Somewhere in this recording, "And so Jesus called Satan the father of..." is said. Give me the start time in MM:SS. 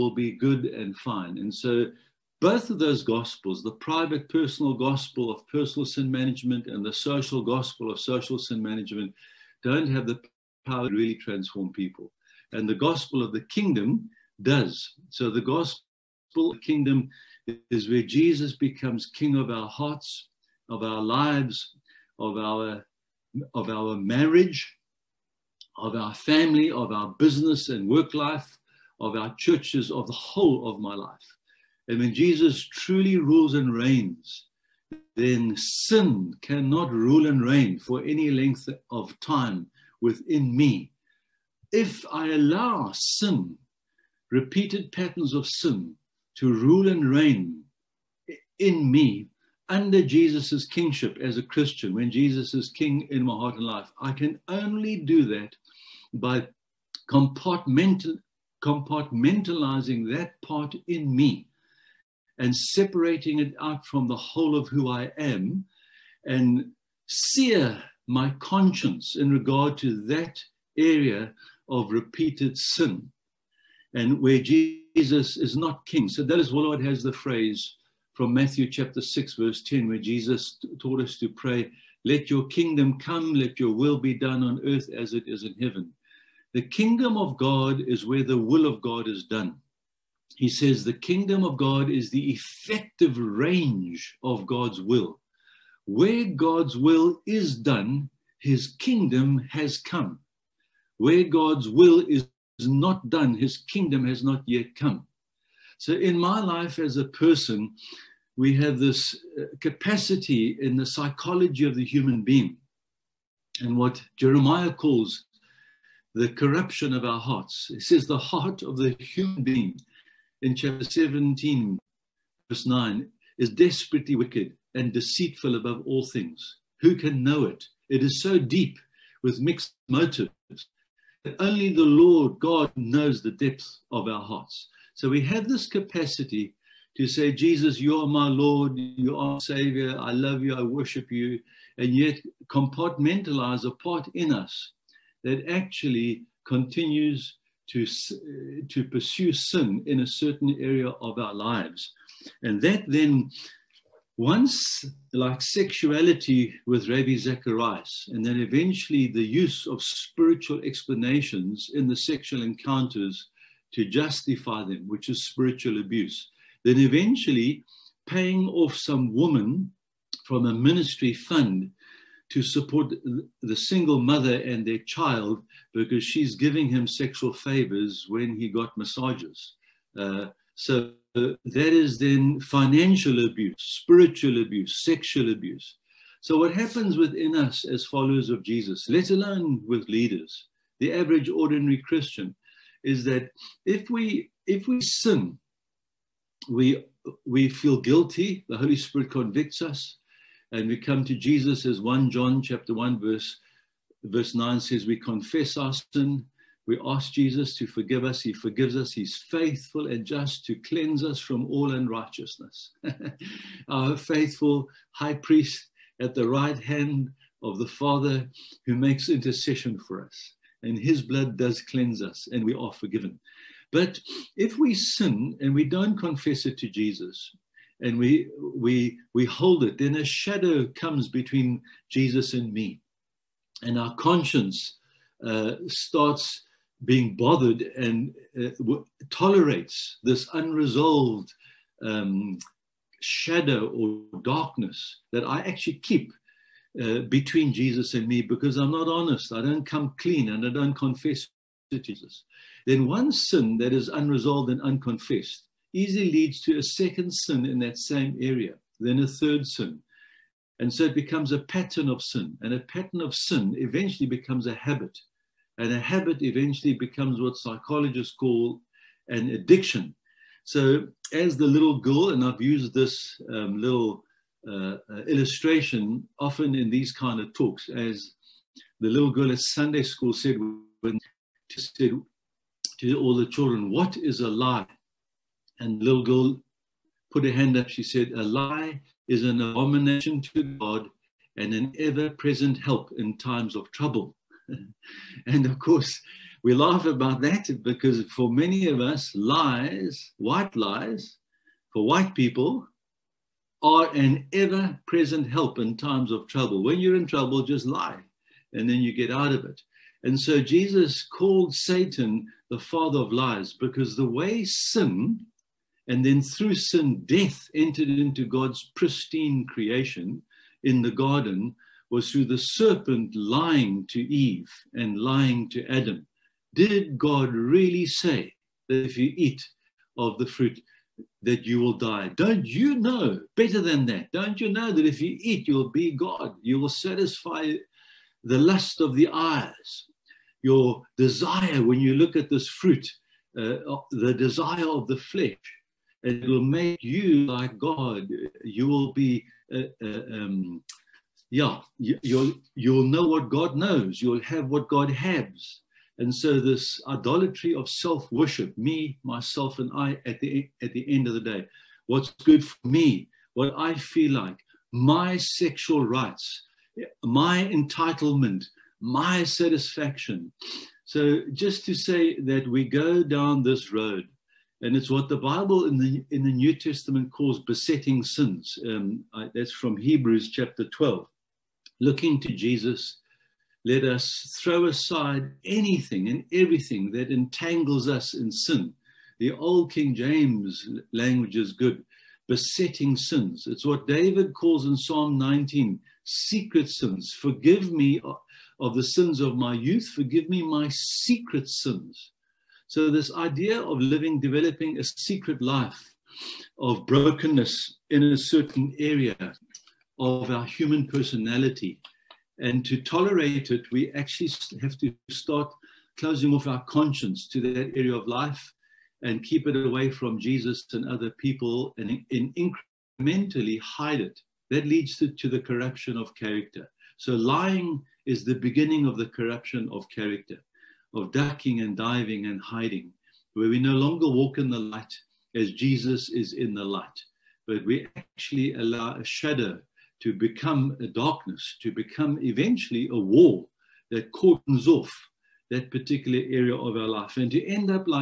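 05:10.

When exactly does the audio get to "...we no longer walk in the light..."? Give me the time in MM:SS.
07:13.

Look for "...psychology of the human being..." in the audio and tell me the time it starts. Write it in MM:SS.
01:50.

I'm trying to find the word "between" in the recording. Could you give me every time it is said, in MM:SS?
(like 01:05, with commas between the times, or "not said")
03:51, 04:07.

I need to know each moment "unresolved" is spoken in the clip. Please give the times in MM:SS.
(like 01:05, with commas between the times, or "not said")
04:00, 04:13.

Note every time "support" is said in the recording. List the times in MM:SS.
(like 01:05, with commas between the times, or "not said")
02:52.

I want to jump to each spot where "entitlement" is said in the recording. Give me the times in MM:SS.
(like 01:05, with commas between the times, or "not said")
06:07.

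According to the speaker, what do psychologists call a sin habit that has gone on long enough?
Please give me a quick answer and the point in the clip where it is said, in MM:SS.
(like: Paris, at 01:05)
Addiction, at 04:29.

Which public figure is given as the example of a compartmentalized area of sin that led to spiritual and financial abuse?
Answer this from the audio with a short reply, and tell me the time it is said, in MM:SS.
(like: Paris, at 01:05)
Ravi Zacharias, at 02:36.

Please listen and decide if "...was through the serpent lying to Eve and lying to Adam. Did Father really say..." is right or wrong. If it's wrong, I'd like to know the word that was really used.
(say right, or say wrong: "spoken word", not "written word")
wrong: "God", not "Father".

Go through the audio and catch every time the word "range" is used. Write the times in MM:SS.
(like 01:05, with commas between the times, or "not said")
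01:33.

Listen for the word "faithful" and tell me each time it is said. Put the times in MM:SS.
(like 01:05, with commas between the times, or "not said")
03:29, 03:33.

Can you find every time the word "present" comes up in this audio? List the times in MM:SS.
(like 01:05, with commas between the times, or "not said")
04:52, 05:04.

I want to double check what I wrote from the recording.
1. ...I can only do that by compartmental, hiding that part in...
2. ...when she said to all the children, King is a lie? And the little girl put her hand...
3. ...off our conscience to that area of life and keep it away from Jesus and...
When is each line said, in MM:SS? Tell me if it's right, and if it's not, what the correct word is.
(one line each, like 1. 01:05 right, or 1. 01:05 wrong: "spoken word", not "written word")
1. 00:53 wrong: "compartmentalizing", not "hiding"
2. 04:40 wrong: "What", not "King"
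3. 06:56 right.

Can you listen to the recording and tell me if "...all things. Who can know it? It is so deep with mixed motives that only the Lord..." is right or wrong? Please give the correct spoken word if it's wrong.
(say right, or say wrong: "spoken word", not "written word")
right.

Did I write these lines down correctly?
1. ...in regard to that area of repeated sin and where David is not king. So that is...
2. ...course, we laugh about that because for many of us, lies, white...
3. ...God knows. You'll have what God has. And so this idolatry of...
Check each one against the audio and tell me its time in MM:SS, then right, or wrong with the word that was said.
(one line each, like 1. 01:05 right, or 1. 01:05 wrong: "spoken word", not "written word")
1. 01:09 wrong: "Jesus", not "David"
2. 04:55 right
3. 05:53 right.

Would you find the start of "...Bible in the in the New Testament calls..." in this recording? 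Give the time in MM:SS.
06:15.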